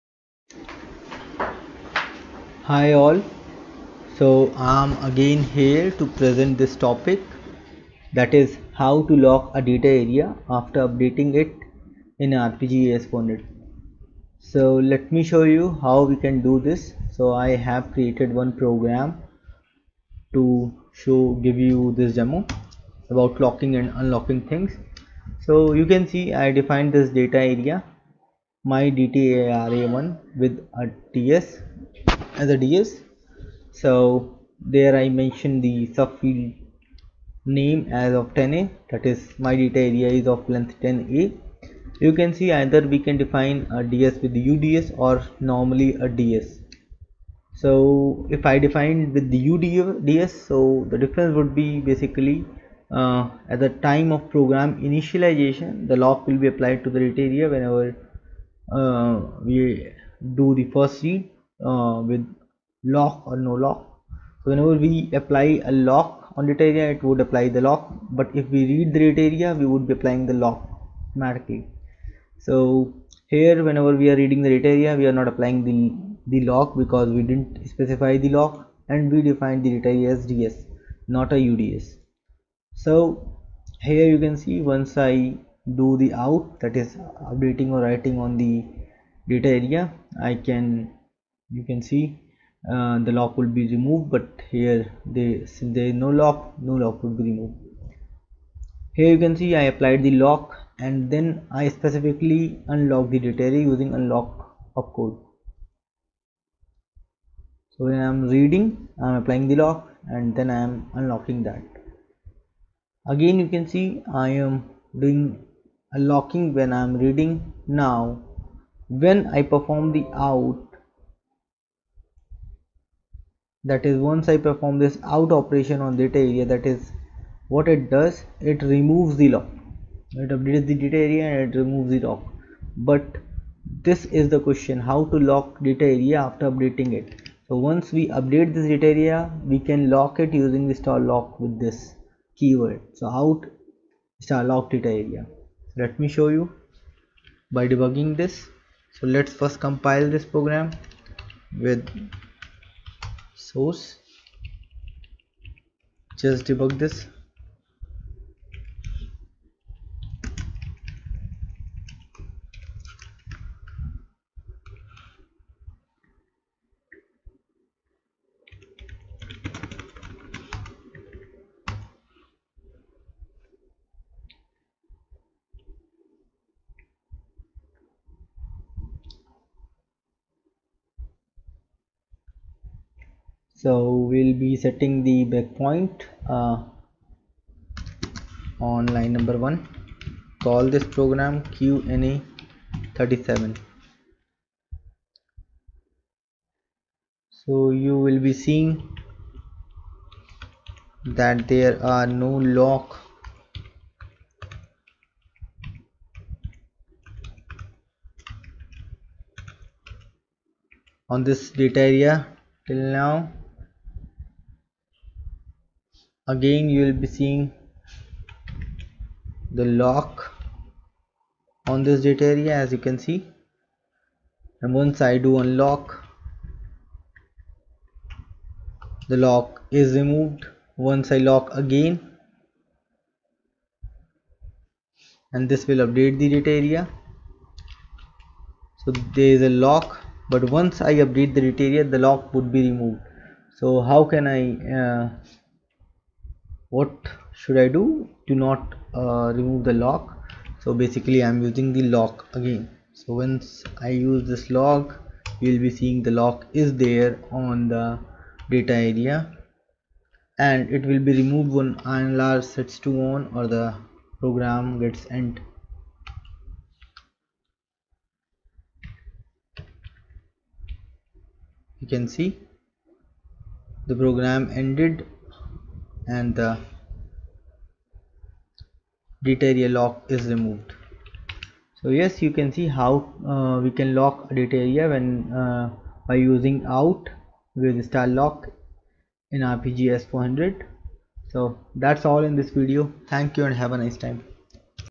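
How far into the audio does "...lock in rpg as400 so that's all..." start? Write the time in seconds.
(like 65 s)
288 s.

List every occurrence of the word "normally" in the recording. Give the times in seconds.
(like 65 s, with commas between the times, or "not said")
45 s.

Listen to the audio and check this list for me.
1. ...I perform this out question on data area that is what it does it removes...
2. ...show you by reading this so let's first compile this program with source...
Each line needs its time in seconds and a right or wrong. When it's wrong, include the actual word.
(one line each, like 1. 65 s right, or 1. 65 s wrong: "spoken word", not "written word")
1. 124 s wrong: "operation", not "question"
2. 146 s wrong: "debugging", not "reading".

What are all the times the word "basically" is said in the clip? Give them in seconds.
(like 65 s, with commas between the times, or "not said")
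51 s, 250 s.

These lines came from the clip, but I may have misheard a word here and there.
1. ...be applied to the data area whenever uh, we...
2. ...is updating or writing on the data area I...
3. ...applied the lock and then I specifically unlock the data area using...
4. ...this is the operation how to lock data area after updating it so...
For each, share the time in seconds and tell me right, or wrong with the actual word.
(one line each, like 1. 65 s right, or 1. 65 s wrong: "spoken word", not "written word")
1. 56 s right
2. 86 s right
3. 99 s right
4. 133 s wrong: "question", not "operation".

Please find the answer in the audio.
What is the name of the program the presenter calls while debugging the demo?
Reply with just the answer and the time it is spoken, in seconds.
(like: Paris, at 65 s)
QNA 37, at 191 s.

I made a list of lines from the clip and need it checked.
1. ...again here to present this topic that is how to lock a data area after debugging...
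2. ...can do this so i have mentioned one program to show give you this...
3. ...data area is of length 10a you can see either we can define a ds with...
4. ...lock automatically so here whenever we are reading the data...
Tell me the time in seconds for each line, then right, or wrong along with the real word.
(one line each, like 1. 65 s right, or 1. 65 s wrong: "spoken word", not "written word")
1. 5 s wrong: "updating", not "debugging"
2. 16 s wrong: "created", not "mentioned"
3. 39 s right
4. 70 s right.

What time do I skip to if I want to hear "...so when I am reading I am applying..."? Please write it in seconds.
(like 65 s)
107 s.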